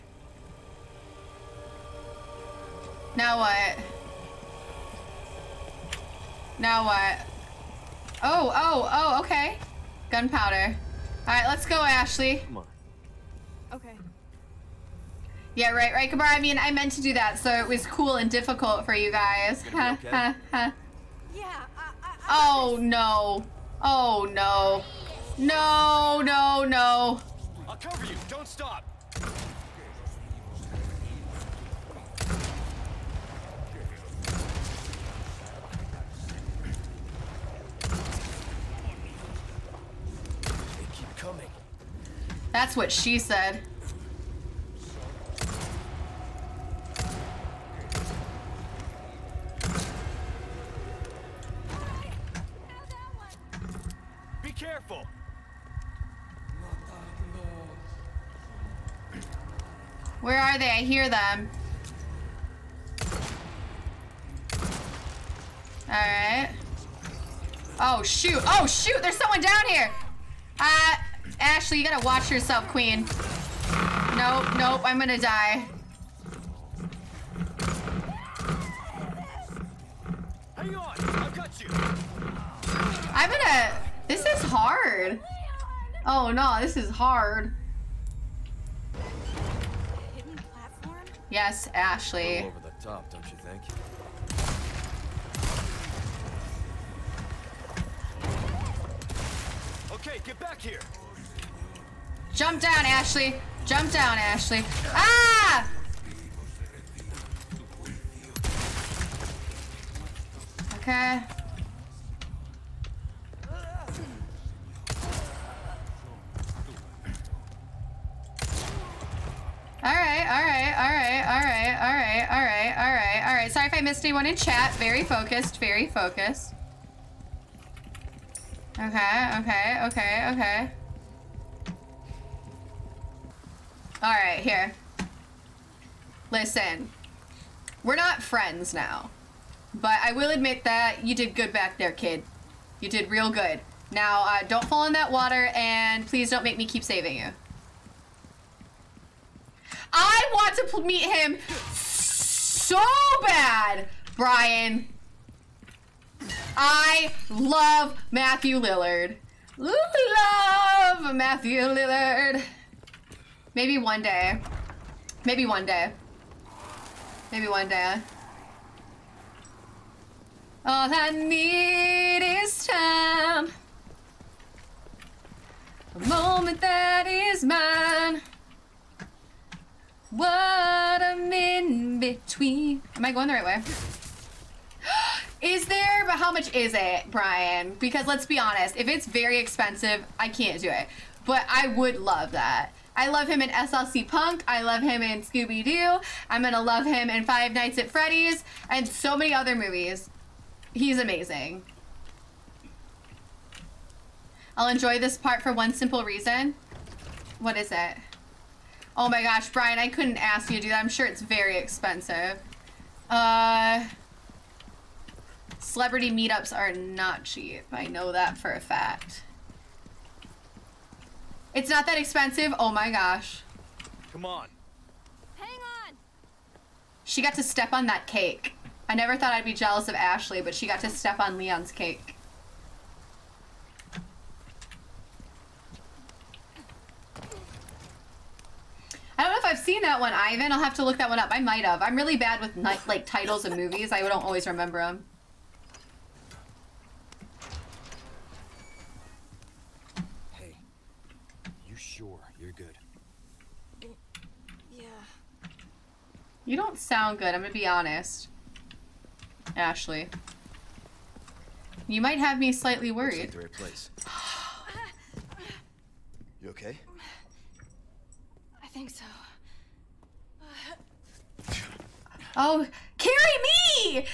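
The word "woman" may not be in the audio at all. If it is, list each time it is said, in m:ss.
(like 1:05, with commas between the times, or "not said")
not said.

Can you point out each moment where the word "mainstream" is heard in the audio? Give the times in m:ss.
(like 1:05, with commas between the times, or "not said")
not said.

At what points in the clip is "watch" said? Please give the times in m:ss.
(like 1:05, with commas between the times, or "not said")
1:12.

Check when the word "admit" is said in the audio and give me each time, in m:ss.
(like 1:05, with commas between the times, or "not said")
2:20.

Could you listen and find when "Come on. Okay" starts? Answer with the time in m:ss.
0:12.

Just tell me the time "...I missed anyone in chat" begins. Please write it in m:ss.
2:03.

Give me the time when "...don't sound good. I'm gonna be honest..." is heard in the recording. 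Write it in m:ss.
4:16.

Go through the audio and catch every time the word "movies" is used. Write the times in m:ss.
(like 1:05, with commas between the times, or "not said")
3:19, 4:03.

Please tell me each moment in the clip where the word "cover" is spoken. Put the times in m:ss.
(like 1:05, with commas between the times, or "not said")
0:27.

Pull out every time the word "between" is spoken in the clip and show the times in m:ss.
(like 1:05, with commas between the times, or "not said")
3:01.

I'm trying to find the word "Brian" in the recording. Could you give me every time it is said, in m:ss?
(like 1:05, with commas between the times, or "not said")
2:34, 3:07, 3:29.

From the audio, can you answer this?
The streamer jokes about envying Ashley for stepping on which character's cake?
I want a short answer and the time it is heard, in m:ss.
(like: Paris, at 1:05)
Leon, at 3:51.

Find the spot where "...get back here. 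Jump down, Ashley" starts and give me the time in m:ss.
1:40.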